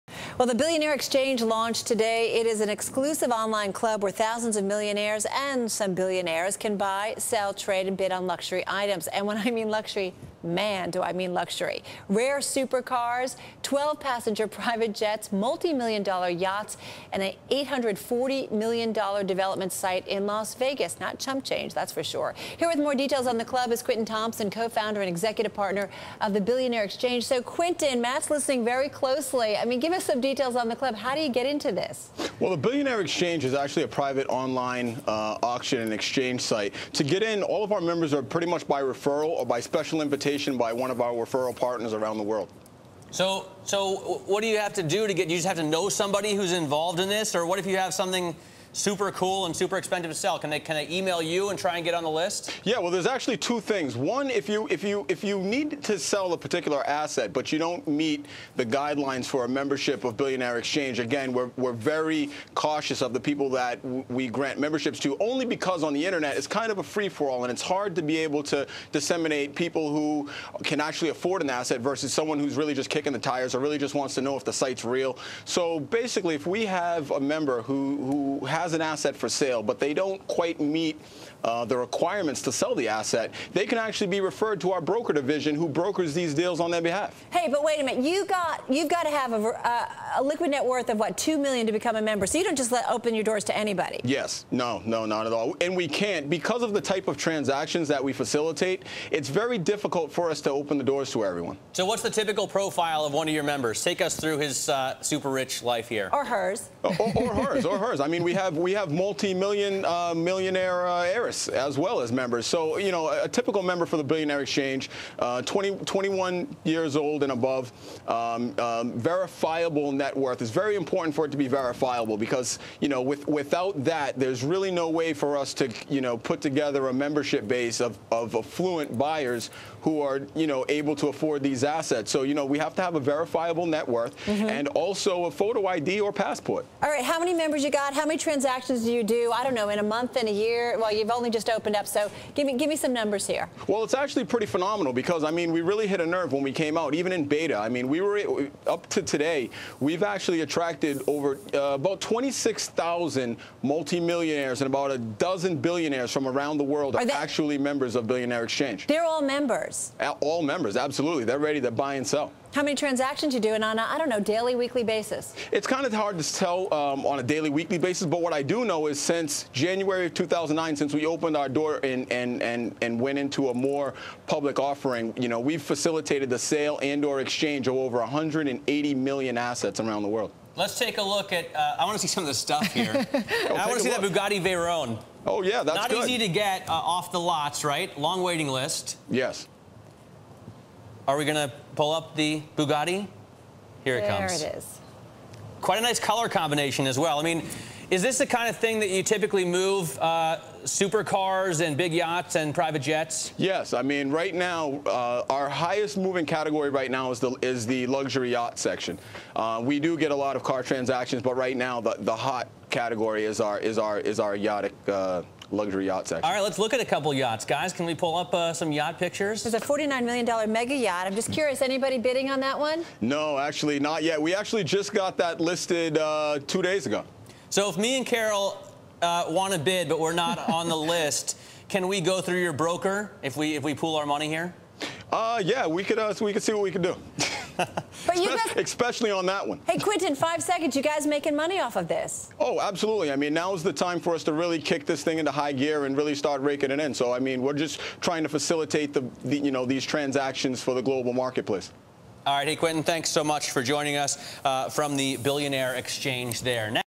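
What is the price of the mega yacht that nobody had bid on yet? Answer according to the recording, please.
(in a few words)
$49 million.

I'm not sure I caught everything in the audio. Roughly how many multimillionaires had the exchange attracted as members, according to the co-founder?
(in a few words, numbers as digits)
26,000.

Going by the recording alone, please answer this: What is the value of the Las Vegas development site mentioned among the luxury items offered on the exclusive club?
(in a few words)
$840 million.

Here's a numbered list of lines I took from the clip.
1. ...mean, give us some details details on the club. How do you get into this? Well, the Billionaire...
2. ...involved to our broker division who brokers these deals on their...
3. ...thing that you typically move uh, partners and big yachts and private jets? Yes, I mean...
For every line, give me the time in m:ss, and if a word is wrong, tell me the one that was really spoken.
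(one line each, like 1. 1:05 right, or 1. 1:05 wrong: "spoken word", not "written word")
1. 0:29 right
2. 1:24 wrong: "referred", not "involved"
3. 3:18 wrong: "supercars", not "partners".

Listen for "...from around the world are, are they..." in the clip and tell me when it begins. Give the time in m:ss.
2:36.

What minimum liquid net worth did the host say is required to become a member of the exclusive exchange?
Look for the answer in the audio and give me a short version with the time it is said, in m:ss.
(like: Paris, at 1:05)
$2 million, at 1:31.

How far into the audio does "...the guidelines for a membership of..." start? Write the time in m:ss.
0:58.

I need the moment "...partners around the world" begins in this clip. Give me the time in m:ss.
0:41.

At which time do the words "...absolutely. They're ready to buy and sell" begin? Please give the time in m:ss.
2:40.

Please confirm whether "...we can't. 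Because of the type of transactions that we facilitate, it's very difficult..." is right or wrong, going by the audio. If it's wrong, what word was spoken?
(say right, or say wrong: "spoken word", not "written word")
right.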